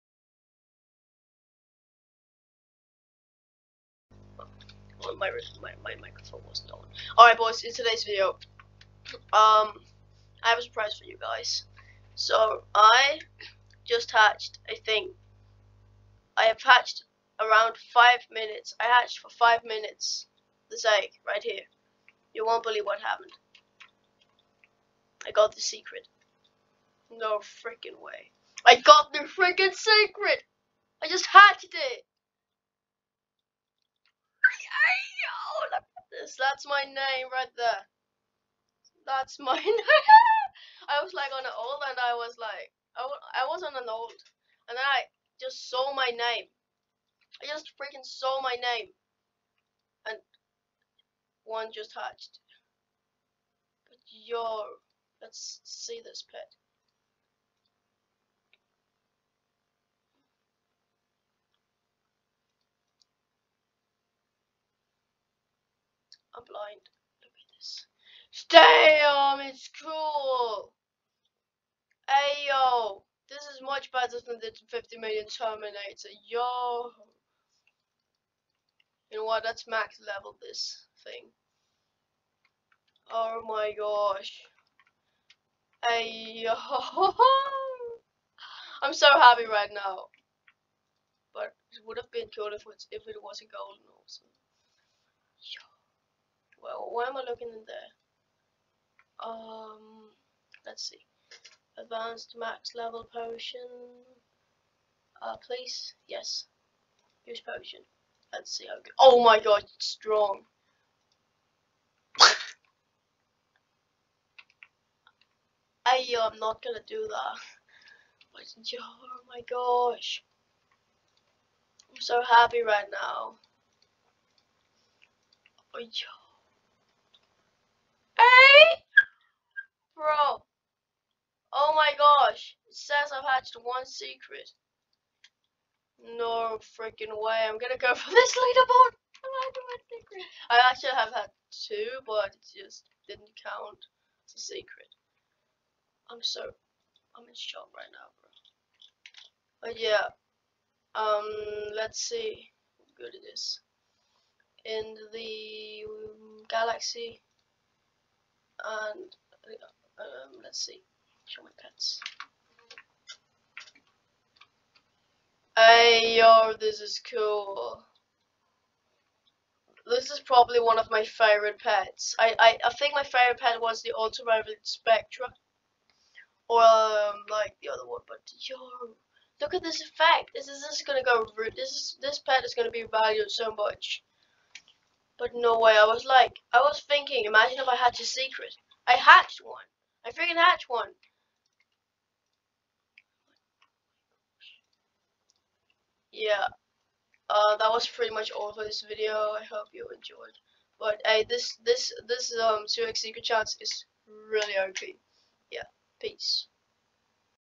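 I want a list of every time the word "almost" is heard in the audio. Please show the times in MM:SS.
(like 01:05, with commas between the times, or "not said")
not said.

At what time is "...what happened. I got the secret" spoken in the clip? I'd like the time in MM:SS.
00:22.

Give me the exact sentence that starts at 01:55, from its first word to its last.
I am not gonna do that.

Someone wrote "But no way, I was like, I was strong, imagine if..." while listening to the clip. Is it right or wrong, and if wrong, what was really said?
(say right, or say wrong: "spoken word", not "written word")
wrong: "thinking", not "strong".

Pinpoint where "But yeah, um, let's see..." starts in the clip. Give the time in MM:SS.
02:29.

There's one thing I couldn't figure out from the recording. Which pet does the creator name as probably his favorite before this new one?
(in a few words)
Ultraviolet Spectra.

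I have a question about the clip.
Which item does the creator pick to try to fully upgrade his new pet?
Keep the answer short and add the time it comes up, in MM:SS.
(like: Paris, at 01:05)
Advanced max level potion, at 01:41.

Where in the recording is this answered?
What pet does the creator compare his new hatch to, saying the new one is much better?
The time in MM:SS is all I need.
01:14.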